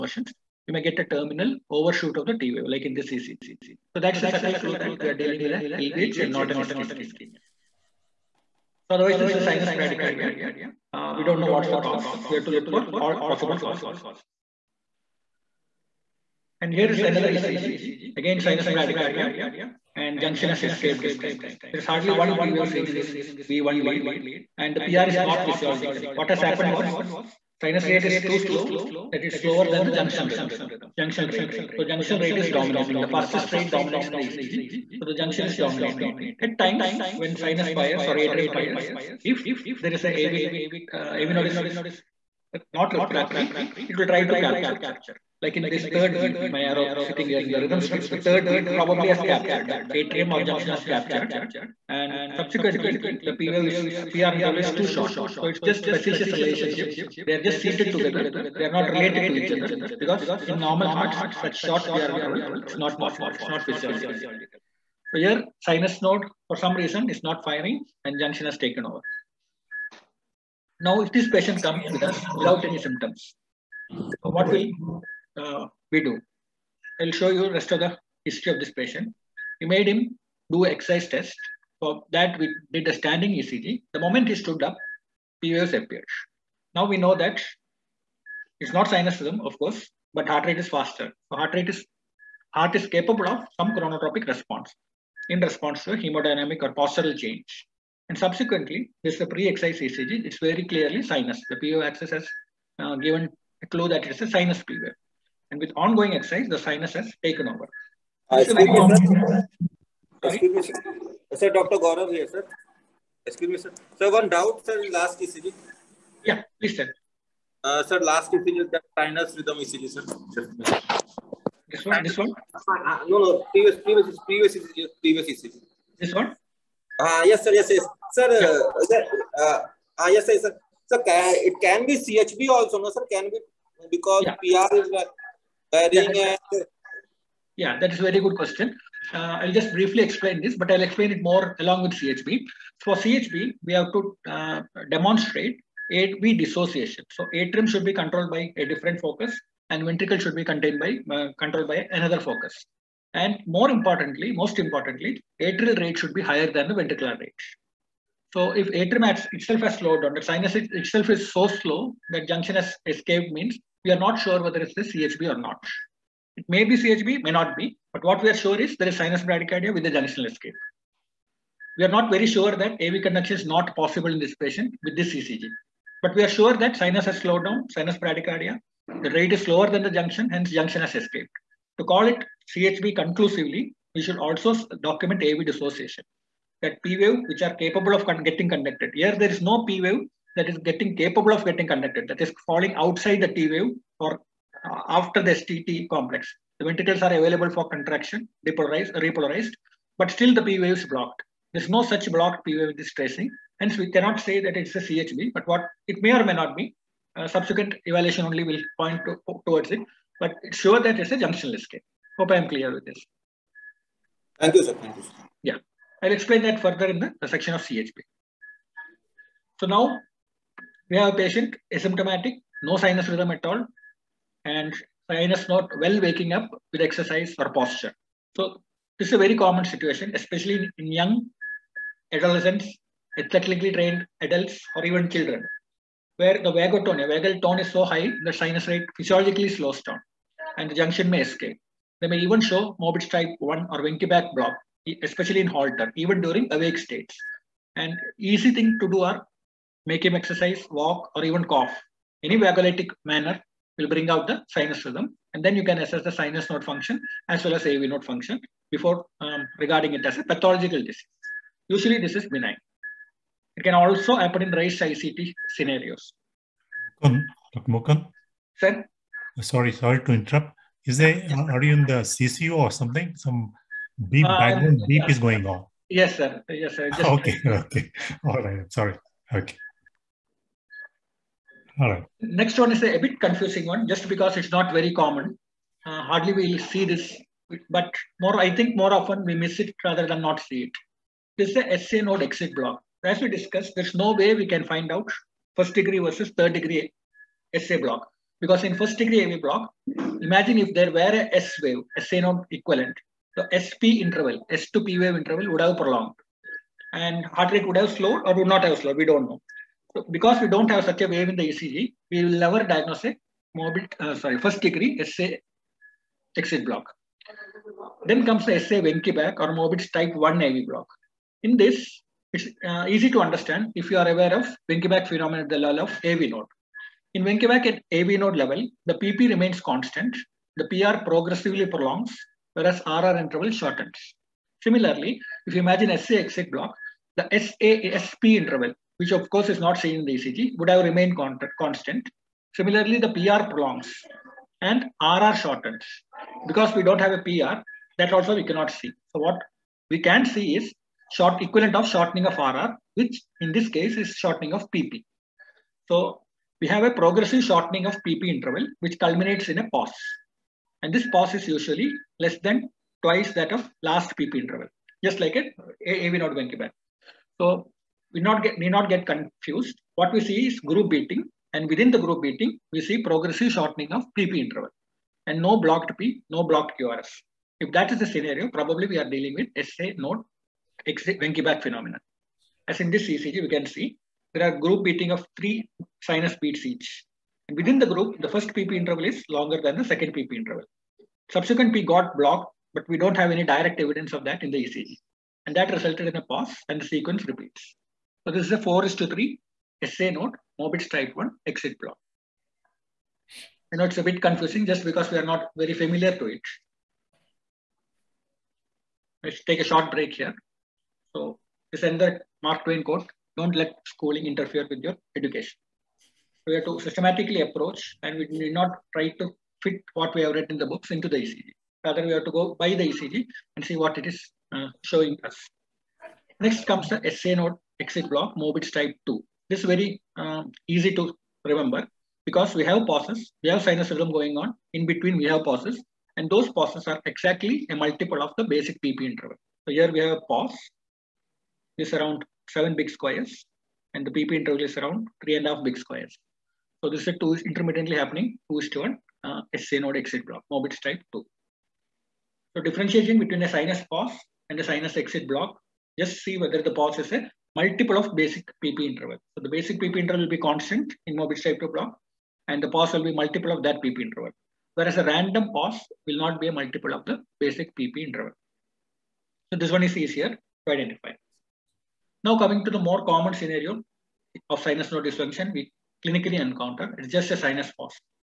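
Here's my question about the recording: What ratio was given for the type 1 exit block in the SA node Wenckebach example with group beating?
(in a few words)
4:3.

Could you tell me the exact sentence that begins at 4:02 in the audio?
They may even show Mobitz type 1 or Wenckebach block, especially in Holter, even during awake states.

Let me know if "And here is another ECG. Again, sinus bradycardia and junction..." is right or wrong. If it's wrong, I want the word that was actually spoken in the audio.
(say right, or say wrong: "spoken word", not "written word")
right.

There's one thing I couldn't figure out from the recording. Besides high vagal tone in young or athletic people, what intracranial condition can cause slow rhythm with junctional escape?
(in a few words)
Raised ICT.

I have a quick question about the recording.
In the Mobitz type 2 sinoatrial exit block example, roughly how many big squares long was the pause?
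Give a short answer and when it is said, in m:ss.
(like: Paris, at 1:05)
7, at 7:22.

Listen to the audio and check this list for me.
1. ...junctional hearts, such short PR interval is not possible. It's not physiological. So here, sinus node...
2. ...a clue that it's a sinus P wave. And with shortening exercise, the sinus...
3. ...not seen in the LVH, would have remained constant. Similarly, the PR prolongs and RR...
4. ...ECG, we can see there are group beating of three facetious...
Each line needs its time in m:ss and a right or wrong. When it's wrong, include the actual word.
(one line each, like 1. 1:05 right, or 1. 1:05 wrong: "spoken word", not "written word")
1. 1:00 wrong: "normal", not "junctional"
2. 1:43 wrong: "ongoing", not "shortening"
3. 5:39 wrong: "ECG", not "LVH"
4. 6:23 wrong: "sinus", not "facetious".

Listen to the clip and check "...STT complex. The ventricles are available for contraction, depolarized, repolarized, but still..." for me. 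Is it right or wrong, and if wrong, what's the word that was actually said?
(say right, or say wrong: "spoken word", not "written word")
right.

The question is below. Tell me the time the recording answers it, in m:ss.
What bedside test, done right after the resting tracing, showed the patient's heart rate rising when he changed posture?
1:22.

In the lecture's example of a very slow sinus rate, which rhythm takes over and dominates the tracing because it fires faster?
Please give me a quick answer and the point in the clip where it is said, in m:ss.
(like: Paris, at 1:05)
Junctional rhythm, at 0:29.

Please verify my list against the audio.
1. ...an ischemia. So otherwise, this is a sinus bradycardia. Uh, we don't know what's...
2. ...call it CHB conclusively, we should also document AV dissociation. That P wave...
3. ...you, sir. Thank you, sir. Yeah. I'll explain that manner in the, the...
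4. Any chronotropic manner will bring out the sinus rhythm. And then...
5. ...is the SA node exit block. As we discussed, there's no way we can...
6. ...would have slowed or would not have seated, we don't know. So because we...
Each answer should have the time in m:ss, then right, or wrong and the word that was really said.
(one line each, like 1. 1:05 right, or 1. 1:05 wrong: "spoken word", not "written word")
1. 0:06 right
2. 3:01 right
3. 3:34 wrong: "further", not "manner"
4. 4:12 wrong: "vagolytic", not "chronotropic"
5. 4:51 right
6. 5:07 wrong: "slowed", not "seated".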